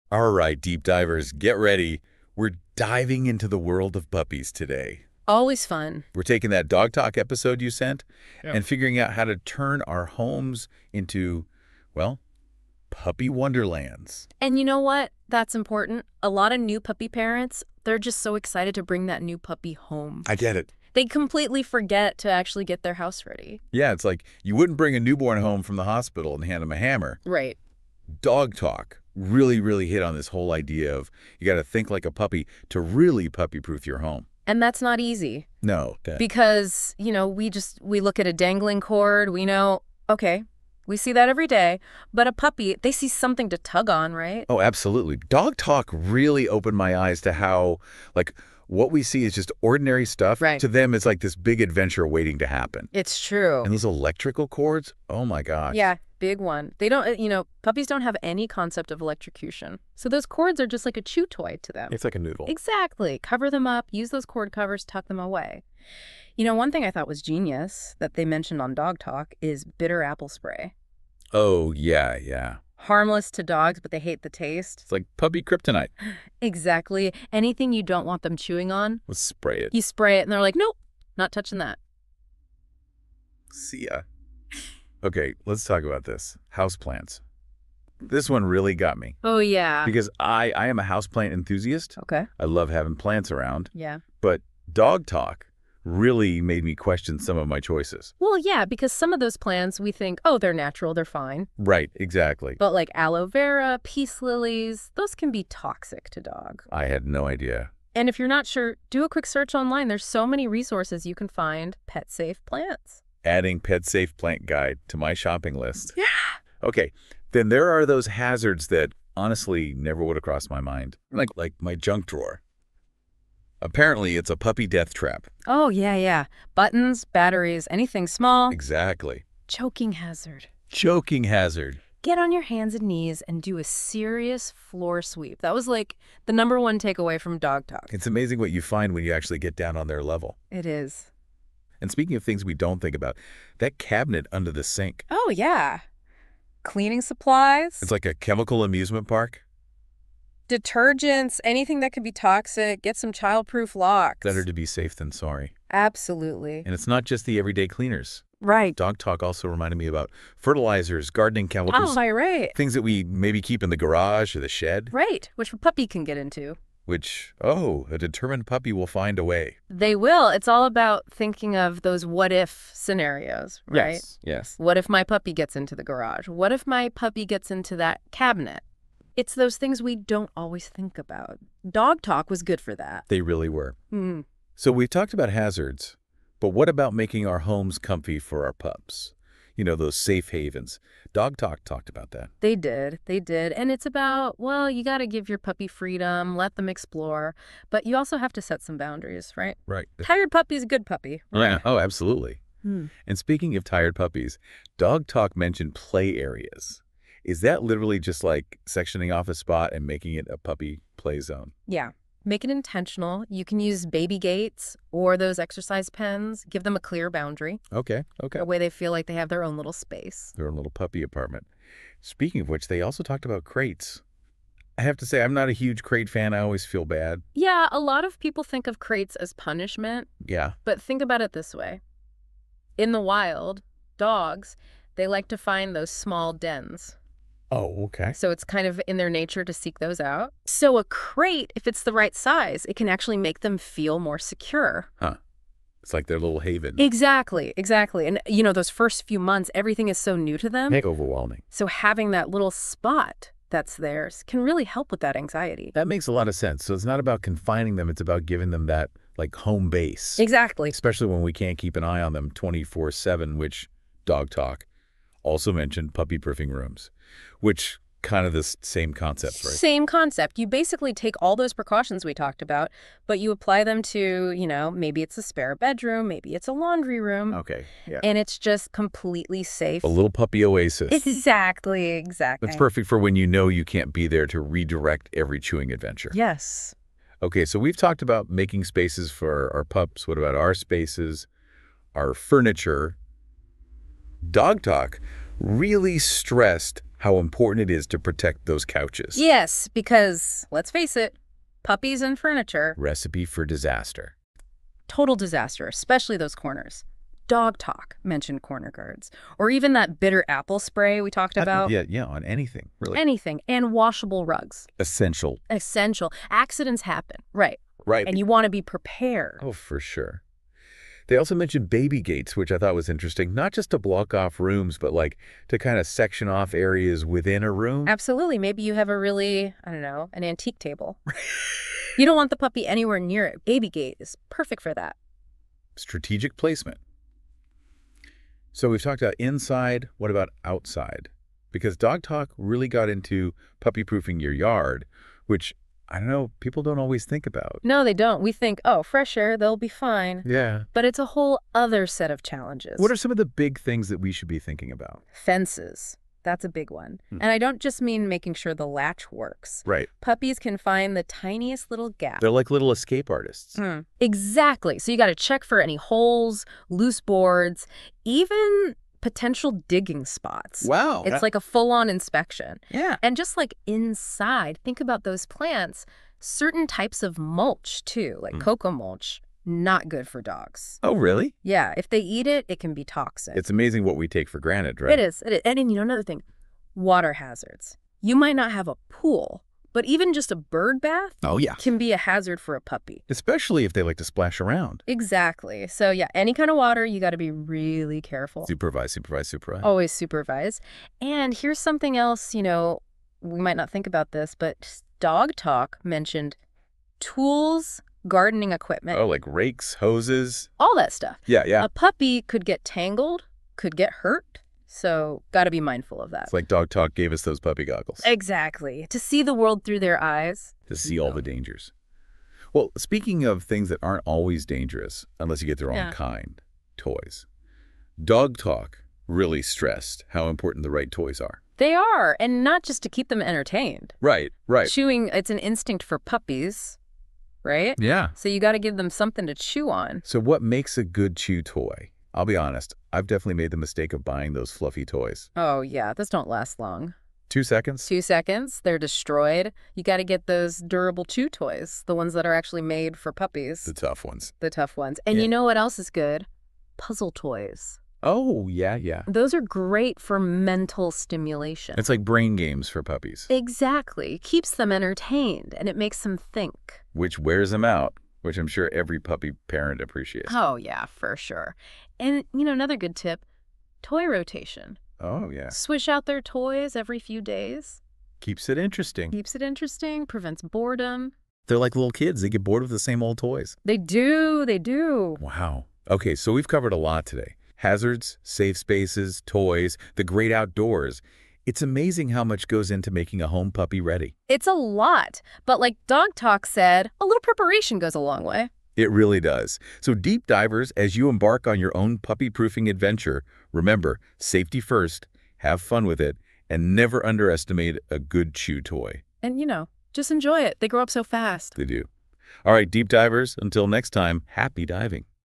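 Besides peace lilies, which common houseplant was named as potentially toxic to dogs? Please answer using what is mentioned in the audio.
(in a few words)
aloe vera.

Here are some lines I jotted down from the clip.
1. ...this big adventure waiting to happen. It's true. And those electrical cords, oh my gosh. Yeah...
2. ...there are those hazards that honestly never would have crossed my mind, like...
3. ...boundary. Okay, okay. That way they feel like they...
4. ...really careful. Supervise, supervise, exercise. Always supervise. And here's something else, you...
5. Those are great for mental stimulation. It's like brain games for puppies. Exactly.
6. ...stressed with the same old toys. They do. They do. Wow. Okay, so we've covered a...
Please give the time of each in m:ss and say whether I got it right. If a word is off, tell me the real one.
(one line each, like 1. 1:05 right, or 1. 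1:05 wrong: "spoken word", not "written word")
1. 0:51 right
2. 1:57 right
3. 3:37 right
4. 6:37 wrong: "supervise", not "exercise"
5. 7:39 right
6. 8:02 wrong: "bored", not "stressed".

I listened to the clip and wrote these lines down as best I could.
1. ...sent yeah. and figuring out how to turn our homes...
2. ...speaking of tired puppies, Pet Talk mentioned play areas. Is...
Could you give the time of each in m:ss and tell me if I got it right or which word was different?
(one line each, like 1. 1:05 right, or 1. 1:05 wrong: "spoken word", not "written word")
1. 0:07 right
2. 3:23 wrong: "Dog", not "Pet".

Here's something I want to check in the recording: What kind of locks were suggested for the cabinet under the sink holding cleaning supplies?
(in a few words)
childproof locks.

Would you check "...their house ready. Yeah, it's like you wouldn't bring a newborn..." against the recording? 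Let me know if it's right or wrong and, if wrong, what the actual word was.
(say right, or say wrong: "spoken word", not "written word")
right.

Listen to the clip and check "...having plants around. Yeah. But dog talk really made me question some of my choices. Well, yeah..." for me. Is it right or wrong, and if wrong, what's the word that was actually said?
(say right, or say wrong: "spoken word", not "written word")
right.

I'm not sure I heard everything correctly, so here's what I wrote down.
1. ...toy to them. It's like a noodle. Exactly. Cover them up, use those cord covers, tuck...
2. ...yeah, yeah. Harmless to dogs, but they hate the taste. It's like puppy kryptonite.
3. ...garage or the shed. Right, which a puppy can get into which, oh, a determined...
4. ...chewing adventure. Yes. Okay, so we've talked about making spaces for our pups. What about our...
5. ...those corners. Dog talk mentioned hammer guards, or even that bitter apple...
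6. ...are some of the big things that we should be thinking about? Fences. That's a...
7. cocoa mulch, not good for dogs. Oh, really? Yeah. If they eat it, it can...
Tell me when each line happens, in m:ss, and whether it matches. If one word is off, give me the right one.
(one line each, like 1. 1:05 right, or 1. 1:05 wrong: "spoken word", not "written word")
1. 1:01 right
2. 1:11 right
3. 2:43 right
4. 4:45 right
5. 5:06 wrong: "corner", not "hammer"
6. 5:52 right
7. 6:18 right.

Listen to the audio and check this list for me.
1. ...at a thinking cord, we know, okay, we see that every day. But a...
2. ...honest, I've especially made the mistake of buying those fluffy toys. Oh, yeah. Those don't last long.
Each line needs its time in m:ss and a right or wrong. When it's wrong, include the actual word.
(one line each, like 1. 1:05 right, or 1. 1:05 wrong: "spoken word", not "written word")
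1. 0:38 wrong: "dangling", not "thinking"
2. 7:22 wrong: "definitely", not "especially".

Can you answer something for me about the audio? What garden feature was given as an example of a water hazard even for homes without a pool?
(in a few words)
bird bath.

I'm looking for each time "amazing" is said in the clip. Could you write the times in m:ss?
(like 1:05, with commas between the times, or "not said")
2:18, 6:23, 8:11.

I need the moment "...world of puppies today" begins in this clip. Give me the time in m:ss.
0:03.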